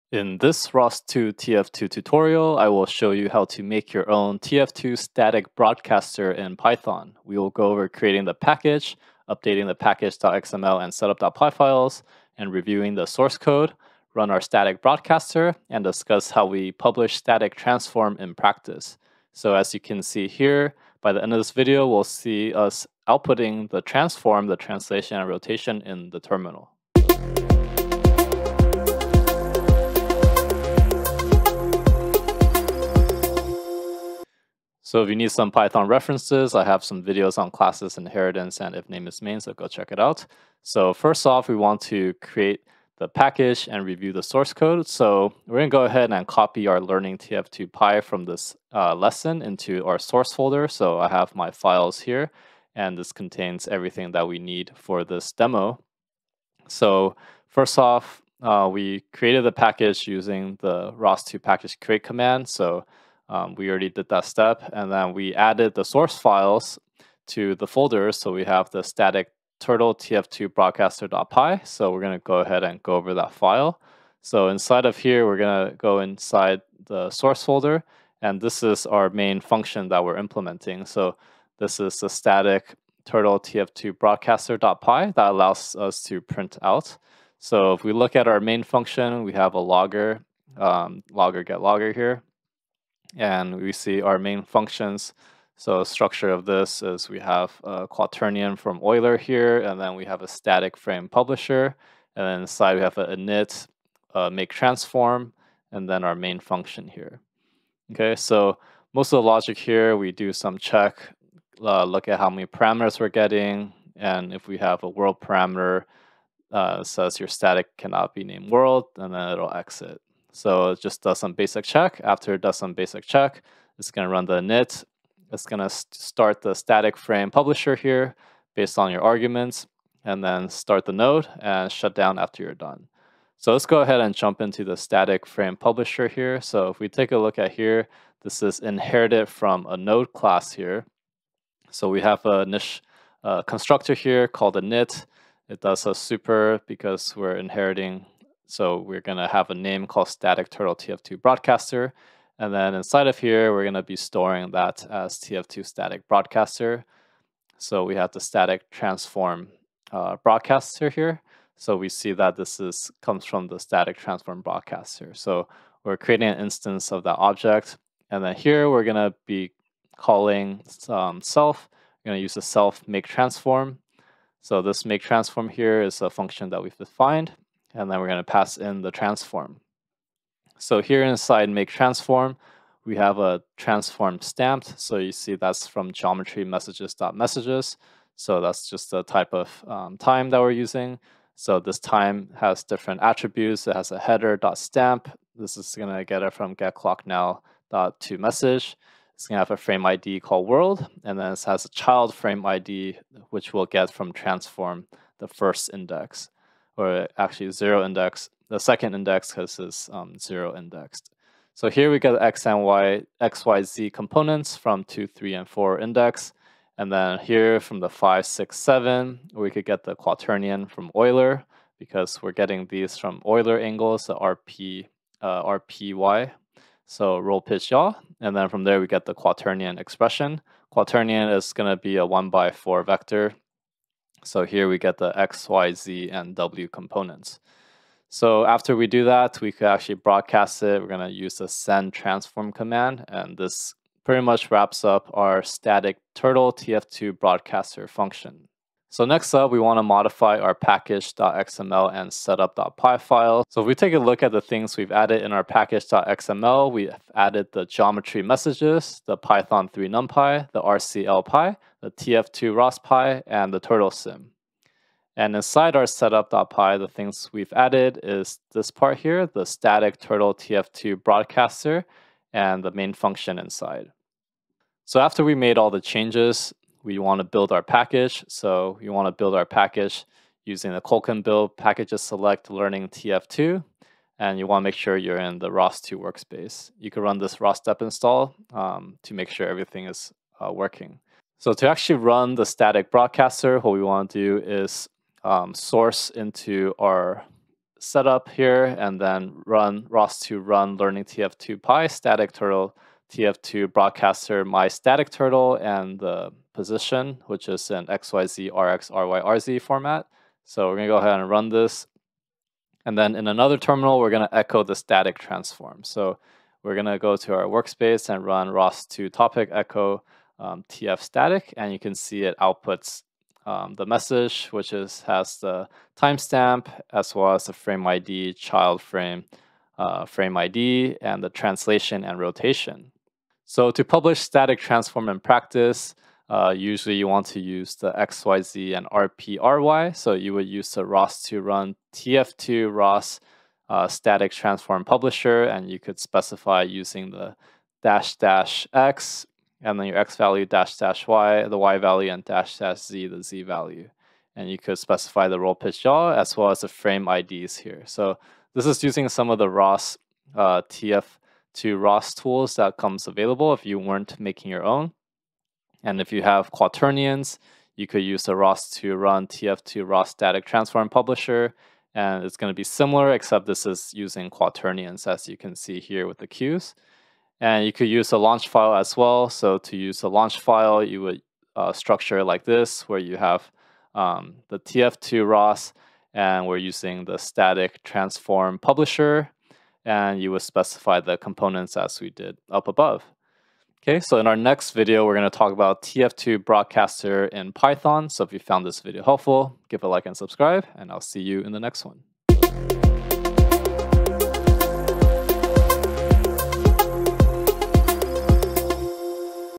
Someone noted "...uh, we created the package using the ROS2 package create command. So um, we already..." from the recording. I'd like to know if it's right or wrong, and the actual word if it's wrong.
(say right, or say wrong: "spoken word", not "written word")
right.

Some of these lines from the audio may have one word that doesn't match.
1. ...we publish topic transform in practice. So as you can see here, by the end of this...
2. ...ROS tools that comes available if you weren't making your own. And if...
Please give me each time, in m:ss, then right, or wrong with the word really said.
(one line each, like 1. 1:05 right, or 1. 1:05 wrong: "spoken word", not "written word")
1. 0:16 wrong: "static", not "topic"
2. 6:01 right.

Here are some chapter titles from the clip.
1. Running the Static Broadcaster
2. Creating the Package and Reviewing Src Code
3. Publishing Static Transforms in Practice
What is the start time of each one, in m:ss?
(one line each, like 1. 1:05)
1. 4:51
2. 0:34
3. 5:33.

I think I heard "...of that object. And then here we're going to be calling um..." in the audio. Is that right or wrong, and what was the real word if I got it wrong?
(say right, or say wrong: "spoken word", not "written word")
right.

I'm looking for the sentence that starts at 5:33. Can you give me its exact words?
So to publish static transform in practice, uh, usually you want to use the XYZ and RPRY.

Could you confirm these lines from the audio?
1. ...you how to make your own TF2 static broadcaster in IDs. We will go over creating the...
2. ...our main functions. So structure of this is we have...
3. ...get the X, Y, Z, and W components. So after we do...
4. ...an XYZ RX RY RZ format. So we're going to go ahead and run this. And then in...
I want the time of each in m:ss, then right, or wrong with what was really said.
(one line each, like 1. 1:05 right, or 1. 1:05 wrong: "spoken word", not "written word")
1. 0:03 wrong: "Python", not "IDs"
2. 1:34 right
3. 3:54 right
4. 5:07 right.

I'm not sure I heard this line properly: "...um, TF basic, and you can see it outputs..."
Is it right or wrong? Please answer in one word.
wrong.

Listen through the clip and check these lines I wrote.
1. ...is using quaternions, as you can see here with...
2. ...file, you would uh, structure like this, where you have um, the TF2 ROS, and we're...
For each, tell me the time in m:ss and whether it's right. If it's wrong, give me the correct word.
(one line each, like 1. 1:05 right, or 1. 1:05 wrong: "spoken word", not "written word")
1. 6:13 right
2. 6:20 right.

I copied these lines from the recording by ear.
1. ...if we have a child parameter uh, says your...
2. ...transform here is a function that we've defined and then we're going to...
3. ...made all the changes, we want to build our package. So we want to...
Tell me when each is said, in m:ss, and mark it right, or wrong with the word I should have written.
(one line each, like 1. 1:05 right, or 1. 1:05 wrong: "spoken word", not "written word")
1. 1:54 wrong: "world", not "child"
2. 2:55 right
3. 4:35 right.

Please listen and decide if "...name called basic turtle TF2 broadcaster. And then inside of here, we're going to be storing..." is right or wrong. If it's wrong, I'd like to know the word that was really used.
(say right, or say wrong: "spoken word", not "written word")
wrong: "static", not "basic".